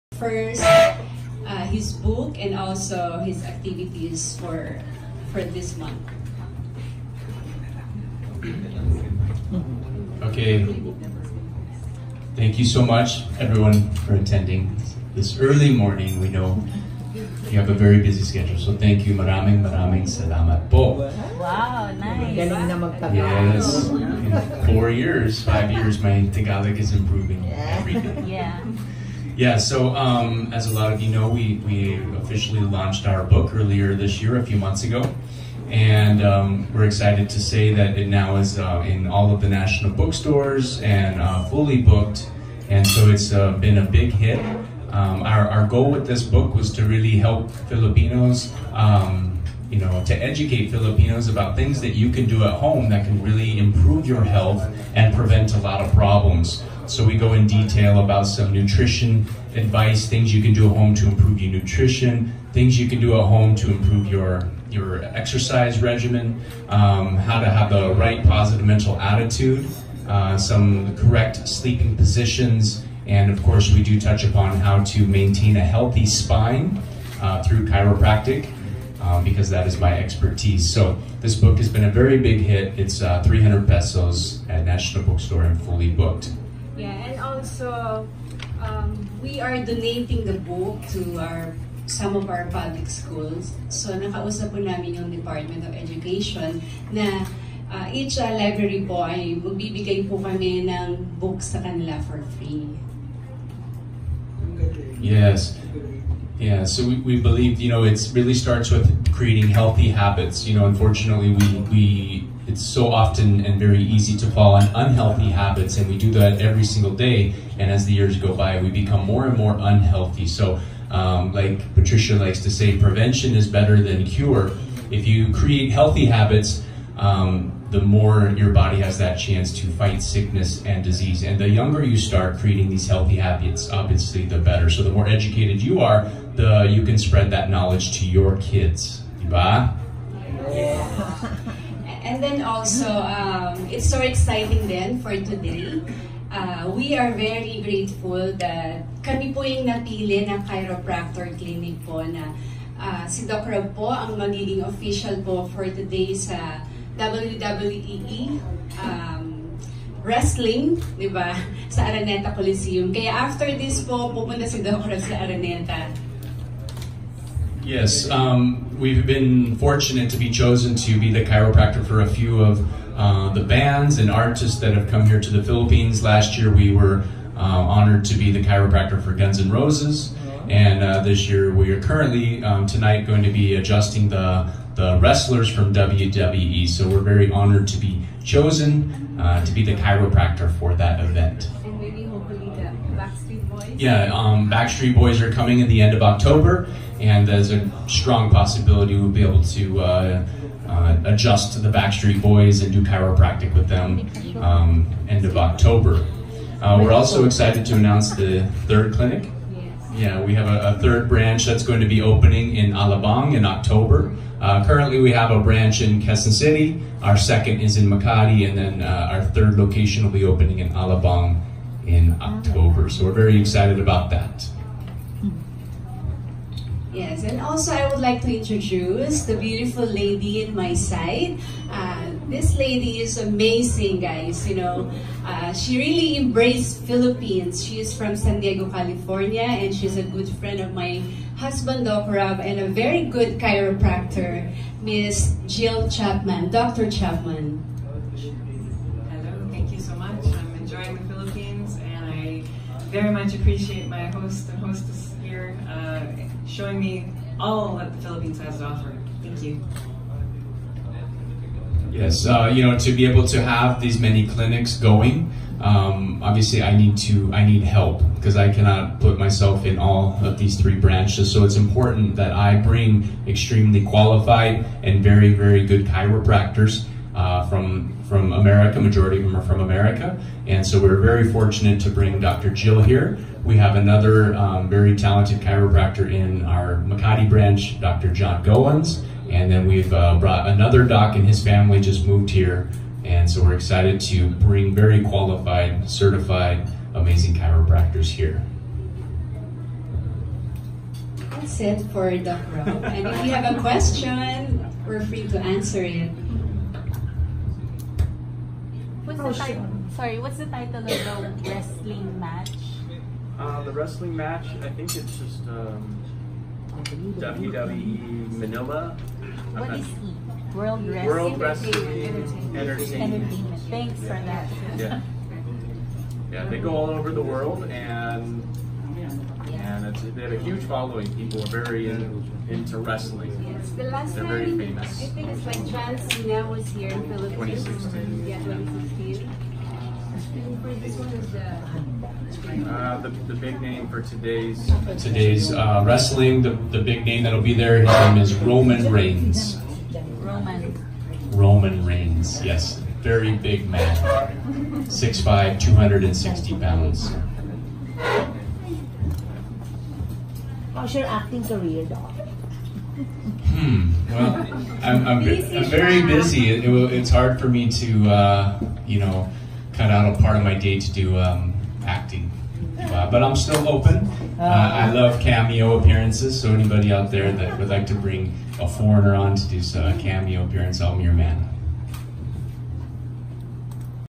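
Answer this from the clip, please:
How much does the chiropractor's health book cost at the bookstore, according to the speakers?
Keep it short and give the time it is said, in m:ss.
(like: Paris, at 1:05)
300 pesos, at 1:23.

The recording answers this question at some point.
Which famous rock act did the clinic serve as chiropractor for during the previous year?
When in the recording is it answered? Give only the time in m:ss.
2:59.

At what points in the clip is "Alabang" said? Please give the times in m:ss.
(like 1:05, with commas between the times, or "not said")
3:32, 3:40.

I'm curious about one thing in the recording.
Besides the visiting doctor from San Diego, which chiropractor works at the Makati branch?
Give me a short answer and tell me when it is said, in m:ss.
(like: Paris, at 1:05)
John Goins, at 4:47.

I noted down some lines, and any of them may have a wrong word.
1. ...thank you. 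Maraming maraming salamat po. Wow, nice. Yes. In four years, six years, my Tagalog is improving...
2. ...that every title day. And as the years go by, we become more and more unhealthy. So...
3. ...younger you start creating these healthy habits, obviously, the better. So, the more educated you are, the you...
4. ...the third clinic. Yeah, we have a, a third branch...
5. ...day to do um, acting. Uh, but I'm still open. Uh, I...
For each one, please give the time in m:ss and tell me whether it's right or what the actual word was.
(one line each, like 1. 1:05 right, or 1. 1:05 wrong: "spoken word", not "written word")
1. 0:18 wrong: "five", not "six"
2. 1:56 wrong: "single", not "title"
3. 2:11 right
4. 3:28 right
5. 6:10 right.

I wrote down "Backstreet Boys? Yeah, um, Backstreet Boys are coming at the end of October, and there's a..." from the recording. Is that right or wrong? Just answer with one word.
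right.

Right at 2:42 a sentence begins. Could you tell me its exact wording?
Kaya after this po, pupunta si Doc Rob sa Araneta.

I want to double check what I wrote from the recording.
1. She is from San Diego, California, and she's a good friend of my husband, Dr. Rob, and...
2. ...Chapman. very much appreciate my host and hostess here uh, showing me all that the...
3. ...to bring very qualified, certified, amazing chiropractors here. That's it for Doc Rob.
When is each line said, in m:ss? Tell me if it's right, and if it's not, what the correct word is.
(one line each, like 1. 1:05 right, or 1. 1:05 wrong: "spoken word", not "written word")
1. 3:57 right
2. 4:06 right
3. 4:54 right.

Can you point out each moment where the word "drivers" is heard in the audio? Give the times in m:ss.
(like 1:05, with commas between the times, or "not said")
not said.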